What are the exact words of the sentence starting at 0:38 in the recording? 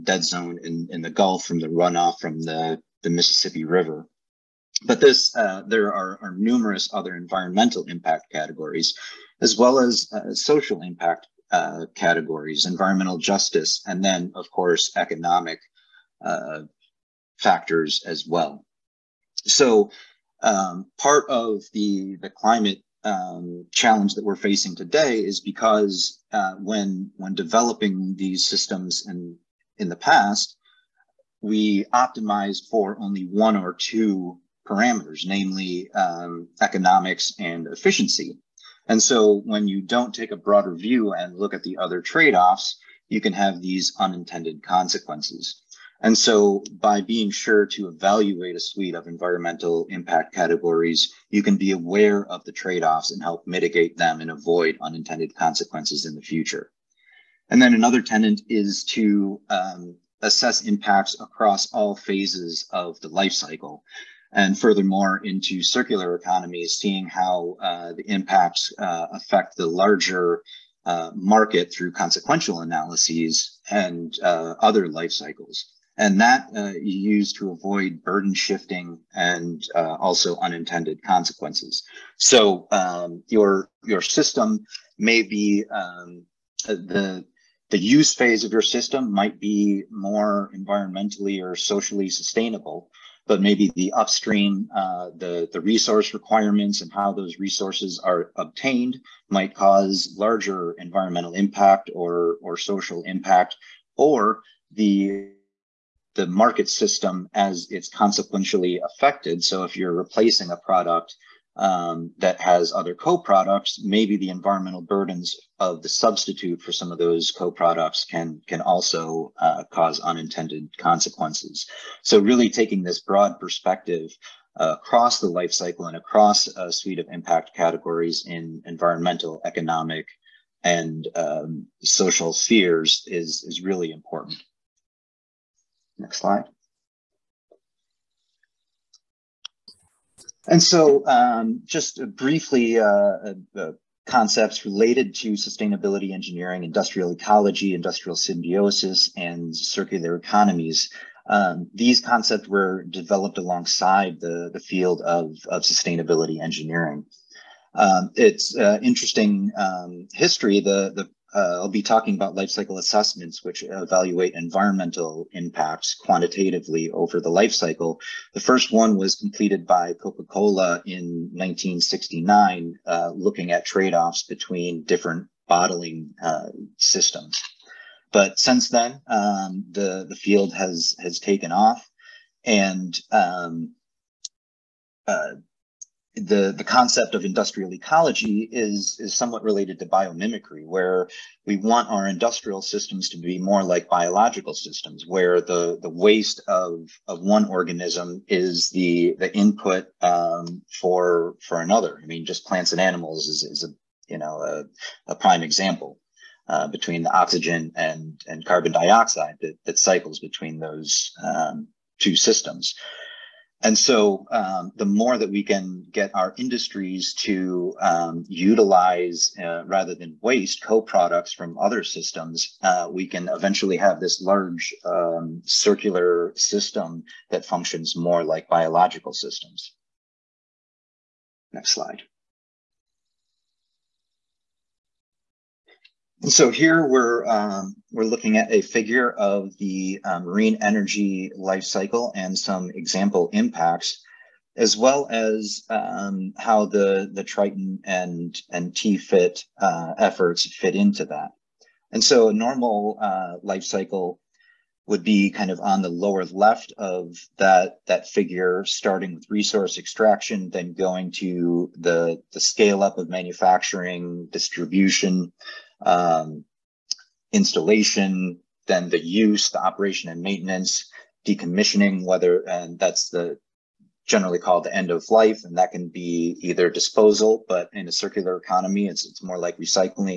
And so when you don't take a broader view and look at the other trade-offs, you can have these unintended consequences.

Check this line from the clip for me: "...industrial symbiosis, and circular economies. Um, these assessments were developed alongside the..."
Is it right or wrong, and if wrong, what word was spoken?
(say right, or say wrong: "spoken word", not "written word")
wrong: "concepts", not "assessments".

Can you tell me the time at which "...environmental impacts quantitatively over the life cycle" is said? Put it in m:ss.
2:44.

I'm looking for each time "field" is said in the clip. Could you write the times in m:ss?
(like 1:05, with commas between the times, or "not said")
2:34, 3:00.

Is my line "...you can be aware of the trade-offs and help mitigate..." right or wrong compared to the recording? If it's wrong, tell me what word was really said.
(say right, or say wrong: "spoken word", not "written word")
right.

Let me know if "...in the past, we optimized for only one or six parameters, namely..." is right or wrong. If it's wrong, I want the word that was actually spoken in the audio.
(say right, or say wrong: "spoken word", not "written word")
wrong: "two", not "six".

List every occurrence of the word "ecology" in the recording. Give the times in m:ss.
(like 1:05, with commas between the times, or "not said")
2:27, 3:07.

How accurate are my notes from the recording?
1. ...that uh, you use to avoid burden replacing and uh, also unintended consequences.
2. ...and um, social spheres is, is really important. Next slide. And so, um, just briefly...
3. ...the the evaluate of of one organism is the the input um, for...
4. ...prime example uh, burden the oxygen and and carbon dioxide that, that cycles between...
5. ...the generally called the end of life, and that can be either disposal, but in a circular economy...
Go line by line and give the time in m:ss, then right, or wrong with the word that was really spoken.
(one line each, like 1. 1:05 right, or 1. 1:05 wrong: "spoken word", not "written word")
1. 1:16 wrong: "shifting", not "replacing"
2. 2:10 right
3. 3:15 wrong: "waste", not "evaluate"
4. 3:25 wrong: "between", not "burden"
5. 4:33 right.